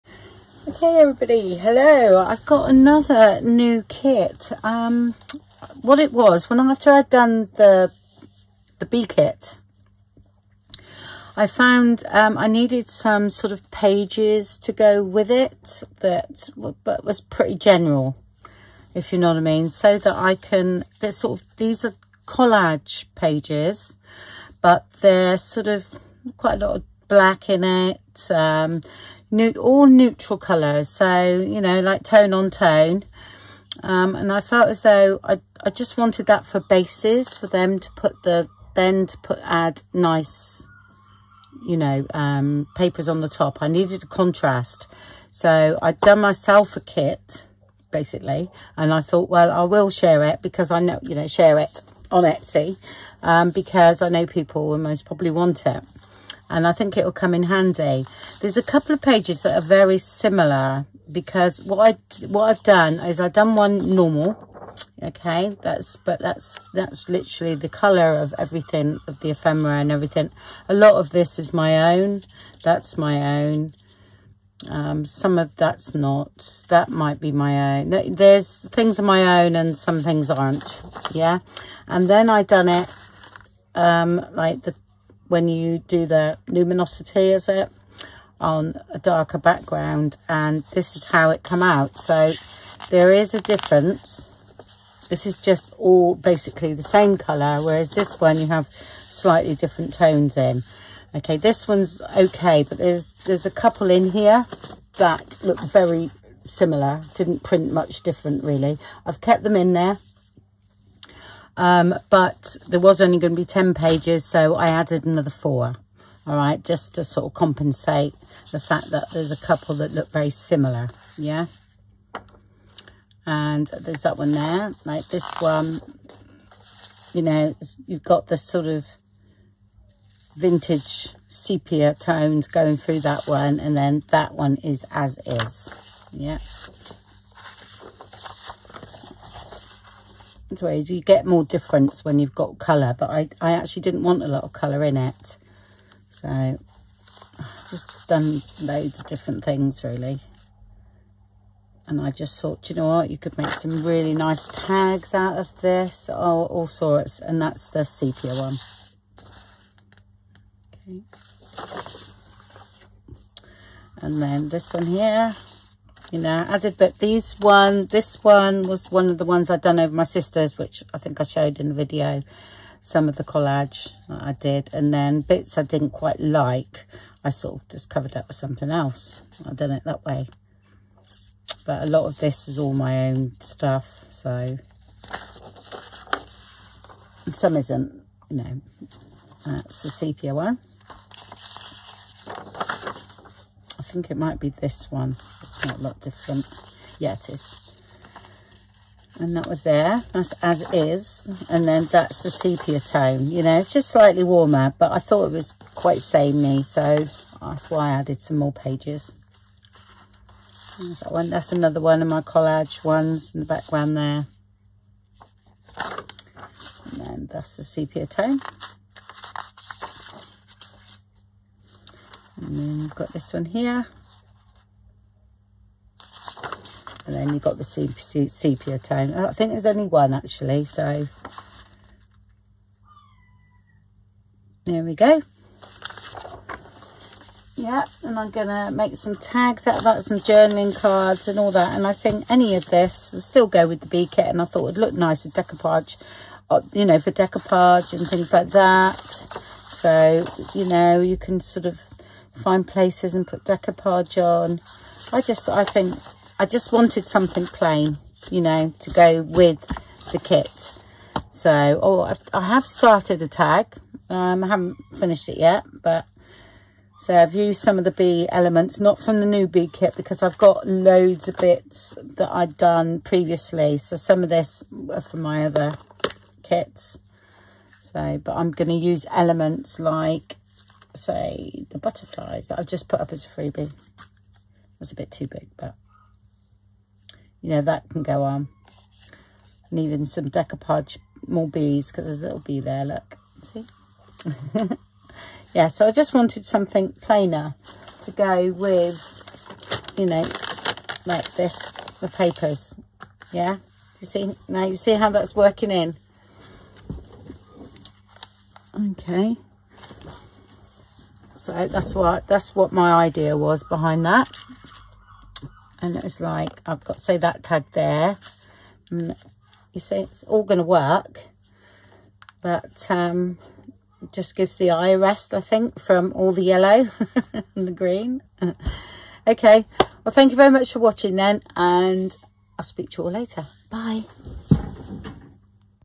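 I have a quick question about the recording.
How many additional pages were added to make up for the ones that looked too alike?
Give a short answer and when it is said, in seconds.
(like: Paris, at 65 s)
4, at 115 s.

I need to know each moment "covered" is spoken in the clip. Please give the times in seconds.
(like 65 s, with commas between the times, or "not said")
177 s.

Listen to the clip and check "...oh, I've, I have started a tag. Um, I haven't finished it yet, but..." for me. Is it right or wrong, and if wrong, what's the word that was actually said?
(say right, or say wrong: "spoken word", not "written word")
right.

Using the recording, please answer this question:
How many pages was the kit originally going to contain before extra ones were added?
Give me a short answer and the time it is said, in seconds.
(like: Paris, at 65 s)
10, at 113 s.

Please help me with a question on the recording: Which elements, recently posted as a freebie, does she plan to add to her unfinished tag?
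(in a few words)
butterflies.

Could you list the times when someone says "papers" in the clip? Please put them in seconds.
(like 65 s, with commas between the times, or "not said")
42 s, 302 s.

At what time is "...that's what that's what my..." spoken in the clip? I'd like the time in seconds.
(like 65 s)
311 s.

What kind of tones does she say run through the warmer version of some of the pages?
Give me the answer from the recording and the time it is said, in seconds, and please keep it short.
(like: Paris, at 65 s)
vintage sepia tones, at 130 s.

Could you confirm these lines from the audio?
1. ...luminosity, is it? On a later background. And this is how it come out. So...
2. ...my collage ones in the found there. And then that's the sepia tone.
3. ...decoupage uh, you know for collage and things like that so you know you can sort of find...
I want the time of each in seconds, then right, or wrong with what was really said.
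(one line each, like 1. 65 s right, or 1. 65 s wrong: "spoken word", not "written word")
1. 86 s wrong: "darker", not "later"
2. 212 s wrong: "background", not "found"
3. 245 s wrong: "decoupage", not "collage".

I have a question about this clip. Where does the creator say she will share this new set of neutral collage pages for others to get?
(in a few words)
Etsy.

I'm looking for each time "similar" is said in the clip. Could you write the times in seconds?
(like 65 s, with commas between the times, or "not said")
59 s, 106 s, 120 s.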